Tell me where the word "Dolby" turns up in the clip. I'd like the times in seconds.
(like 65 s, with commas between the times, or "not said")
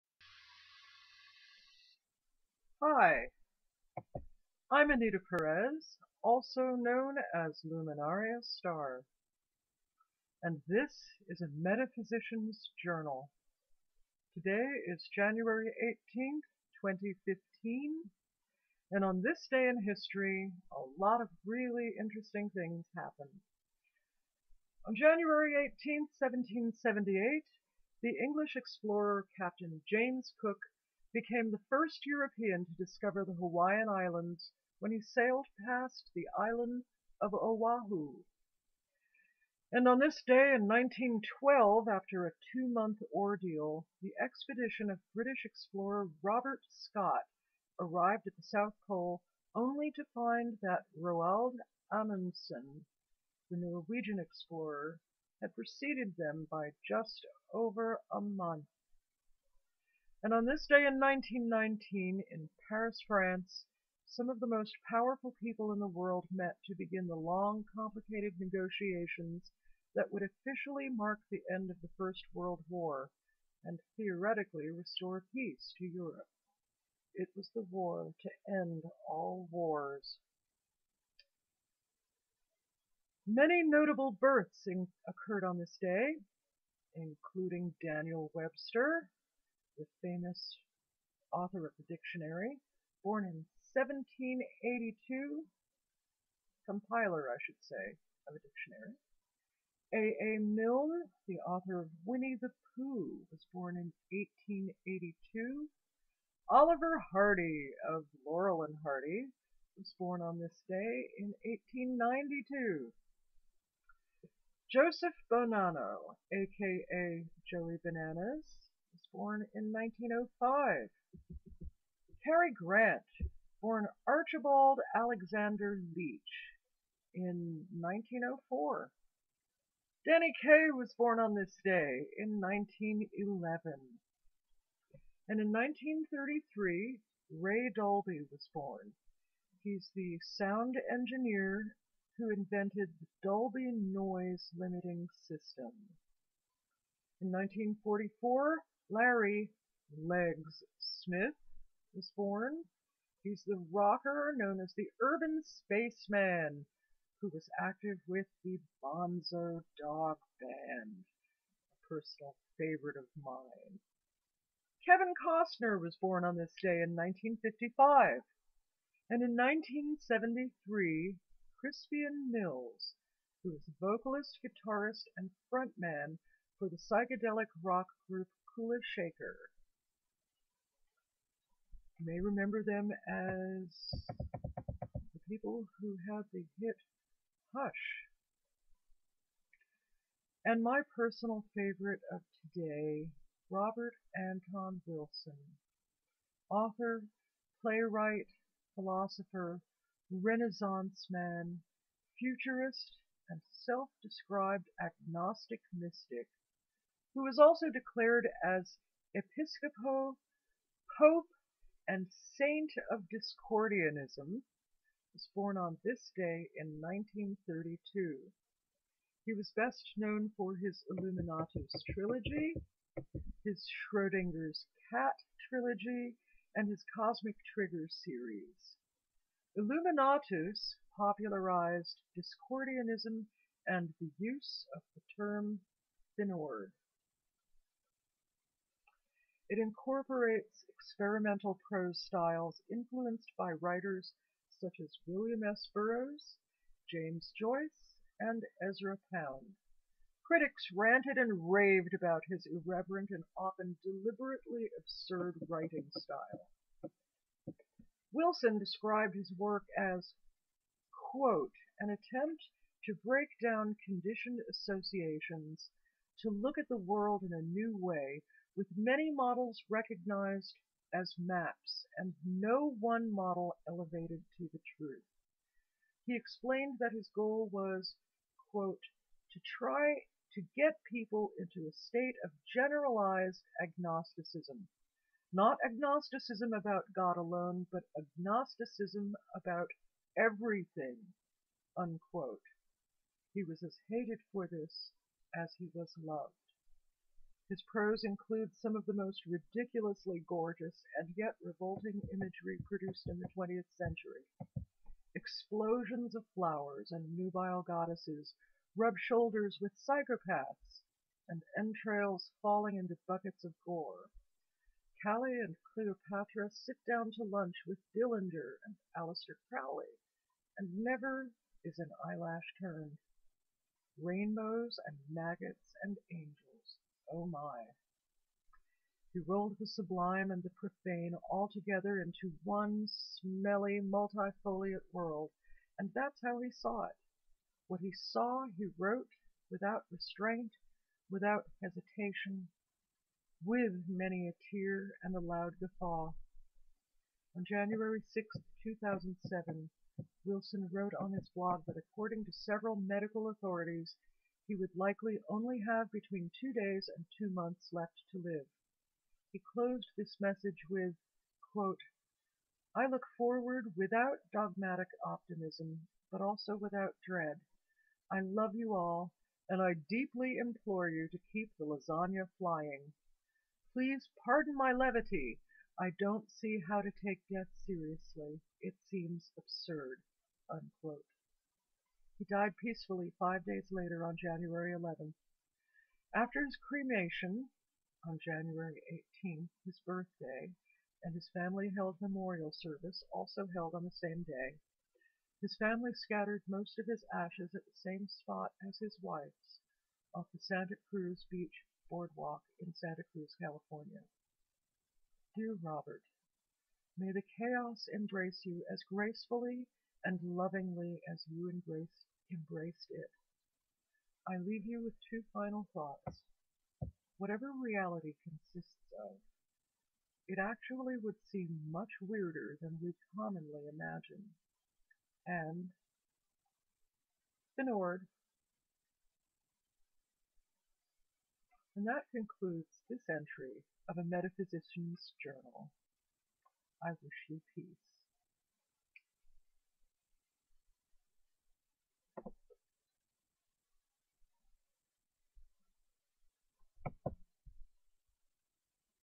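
137 s, 143 s.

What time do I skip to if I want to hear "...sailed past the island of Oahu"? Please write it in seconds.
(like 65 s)
35 s.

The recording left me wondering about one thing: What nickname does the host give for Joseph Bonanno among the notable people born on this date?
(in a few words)
Joey Bananas.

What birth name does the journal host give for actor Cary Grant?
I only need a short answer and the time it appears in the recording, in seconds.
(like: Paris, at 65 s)
Archibald Alexander Leach, at 124 s.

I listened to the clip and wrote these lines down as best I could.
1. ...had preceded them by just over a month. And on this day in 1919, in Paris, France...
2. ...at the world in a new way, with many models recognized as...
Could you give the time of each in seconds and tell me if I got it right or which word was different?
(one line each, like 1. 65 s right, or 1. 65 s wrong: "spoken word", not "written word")
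1. 55 s right
2. 266 s right.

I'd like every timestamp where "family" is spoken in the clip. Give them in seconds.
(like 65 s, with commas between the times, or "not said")
391 s, 395 s.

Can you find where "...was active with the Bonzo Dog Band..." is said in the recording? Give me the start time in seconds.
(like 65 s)
157 s.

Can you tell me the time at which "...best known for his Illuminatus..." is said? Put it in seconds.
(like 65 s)
219 s.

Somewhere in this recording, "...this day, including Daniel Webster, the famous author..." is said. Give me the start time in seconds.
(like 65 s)
85 s.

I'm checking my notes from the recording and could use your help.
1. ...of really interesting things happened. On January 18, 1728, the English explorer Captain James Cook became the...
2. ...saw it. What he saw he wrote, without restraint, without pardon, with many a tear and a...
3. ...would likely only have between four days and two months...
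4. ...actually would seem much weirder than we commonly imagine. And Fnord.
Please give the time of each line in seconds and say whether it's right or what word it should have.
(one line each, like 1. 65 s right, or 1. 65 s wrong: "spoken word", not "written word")
1. 21 s wrong: "1778", not "1728"
2. 336 s wrong: "hesitation", not "pardon"
3. 354 s wrong: "two", not "four"
4. 420 s right.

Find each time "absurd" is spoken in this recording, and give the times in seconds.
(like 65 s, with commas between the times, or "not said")
254 s, 379 s.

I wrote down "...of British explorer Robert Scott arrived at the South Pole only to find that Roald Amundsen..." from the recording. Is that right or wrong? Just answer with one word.
right.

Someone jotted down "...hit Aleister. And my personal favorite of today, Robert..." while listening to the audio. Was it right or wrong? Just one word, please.
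wrong.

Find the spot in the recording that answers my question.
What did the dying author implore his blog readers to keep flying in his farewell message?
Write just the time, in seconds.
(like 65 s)
371 s.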